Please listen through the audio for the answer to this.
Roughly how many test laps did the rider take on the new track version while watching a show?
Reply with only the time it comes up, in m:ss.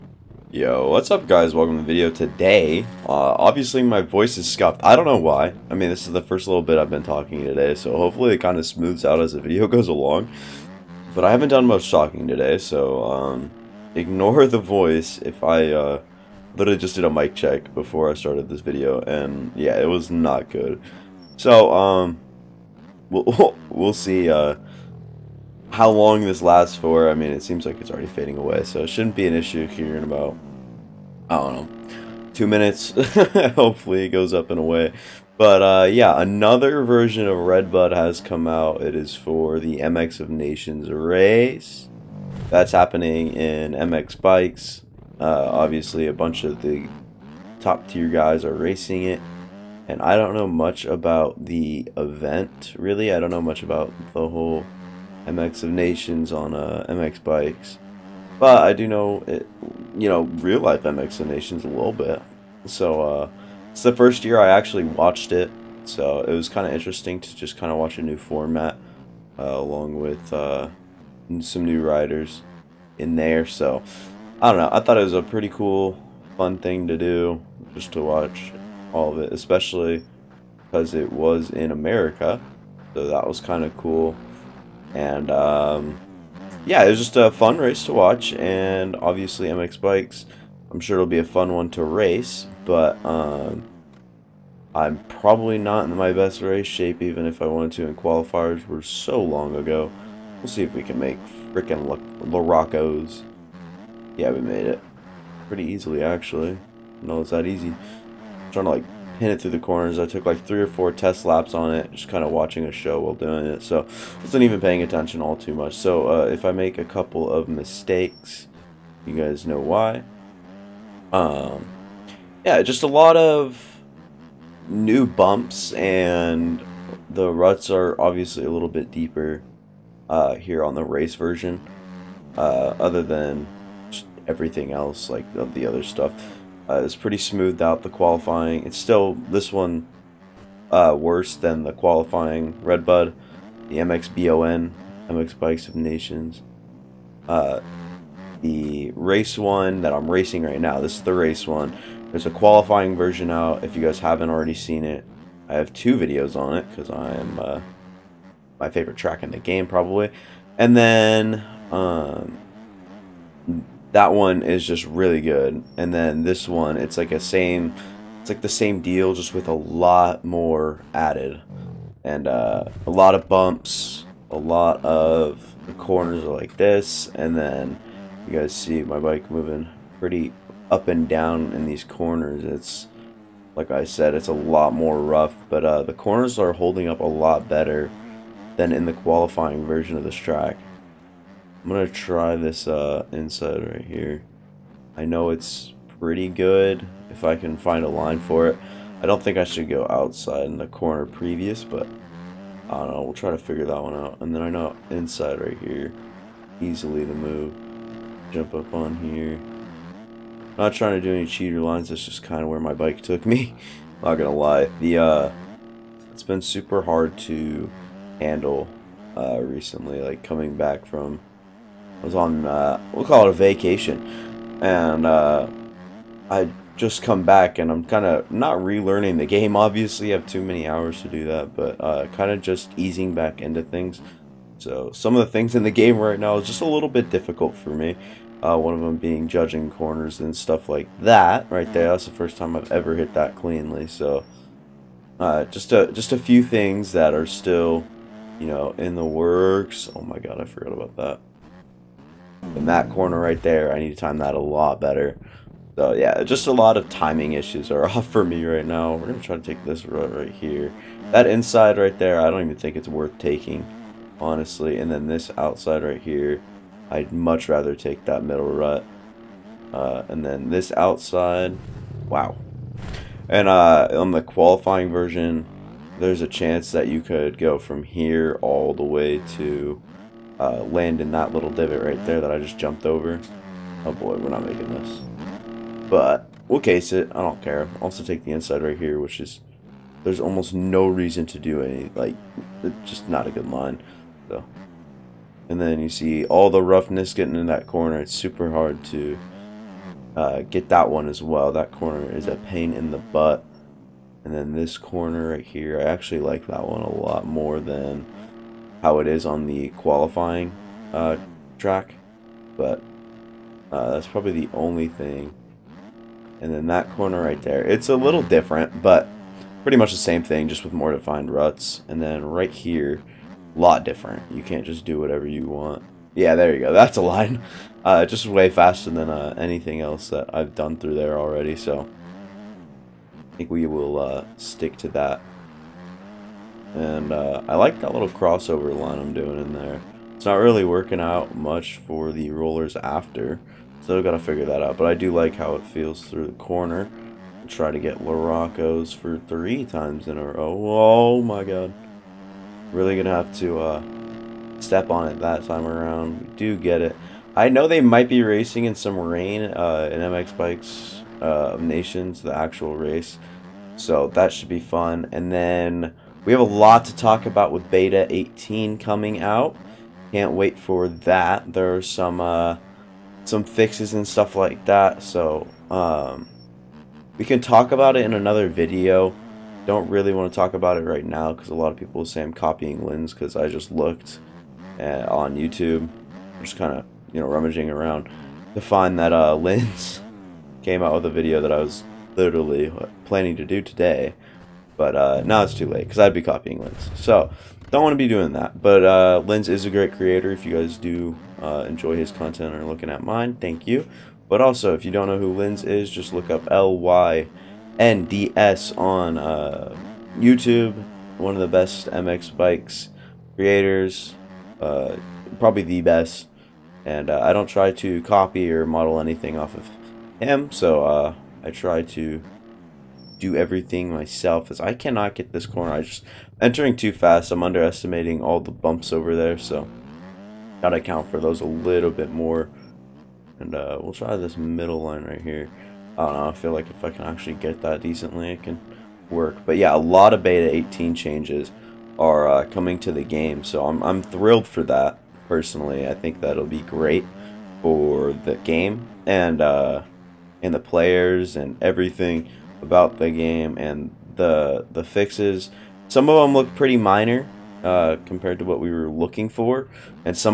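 1:50.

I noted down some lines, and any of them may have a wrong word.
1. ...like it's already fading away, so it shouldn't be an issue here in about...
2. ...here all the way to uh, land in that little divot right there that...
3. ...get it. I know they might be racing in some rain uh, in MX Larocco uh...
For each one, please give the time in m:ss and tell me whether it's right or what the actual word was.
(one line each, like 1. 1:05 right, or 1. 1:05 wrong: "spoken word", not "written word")
1. 0:27 right
2. 4:37 right
3. 5:56 wrong: "Bikes", not "Larocco".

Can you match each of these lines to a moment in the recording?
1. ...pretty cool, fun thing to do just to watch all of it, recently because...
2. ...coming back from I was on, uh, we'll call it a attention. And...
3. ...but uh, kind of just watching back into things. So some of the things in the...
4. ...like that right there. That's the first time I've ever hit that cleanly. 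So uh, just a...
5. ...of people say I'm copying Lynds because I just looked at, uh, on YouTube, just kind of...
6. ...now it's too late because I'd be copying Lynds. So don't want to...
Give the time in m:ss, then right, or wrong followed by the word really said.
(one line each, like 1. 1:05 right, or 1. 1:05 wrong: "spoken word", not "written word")
1. 1:15 wrong: "especially", not "recently"
2. 3:40 wrong: "vacation", not "attention"
3. 3:51 wrong: "easing", not "watching"
4. 4:00 right
5. 6:21 right
6. 6:35 right.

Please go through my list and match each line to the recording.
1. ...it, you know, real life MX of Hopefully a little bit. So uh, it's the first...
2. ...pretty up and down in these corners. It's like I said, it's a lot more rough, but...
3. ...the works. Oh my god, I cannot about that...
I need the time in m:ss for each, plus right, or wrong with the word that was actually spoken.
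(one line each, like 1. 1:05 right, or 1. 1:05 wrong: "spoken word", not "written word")
1. 0:59 wrong: "Nations", not "Hopefully"
2. 2:59 right
3. 4:08 wrong: "forgot", not "cannot".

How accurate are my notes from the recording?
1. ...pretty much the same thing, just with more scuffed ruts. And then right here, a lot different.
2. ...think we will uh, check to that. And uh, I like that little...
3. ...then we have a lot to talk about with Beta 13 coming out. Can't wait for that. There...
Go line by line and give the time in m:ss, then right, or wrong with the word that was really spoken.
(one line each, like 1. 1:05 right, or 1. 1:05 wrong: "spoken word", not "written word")
1. 5:19 wrong: "defined", not "scuffed"
2. 5:33 wrong: "stick", not "check"
3. 6:05 wrong: "18", not "13".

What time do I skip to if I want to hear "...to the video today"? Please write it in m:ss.
0:01.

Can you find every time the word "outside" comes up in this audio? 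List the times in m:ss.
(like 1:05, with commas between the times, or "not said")
3:19, 4:25, 4:30.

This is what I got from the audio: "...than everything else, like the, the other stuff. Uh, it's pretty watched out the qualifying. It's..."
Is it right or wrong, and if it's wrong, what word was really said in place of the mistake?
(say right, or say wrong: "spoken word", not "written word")
wrong: "smoothed", not "watched".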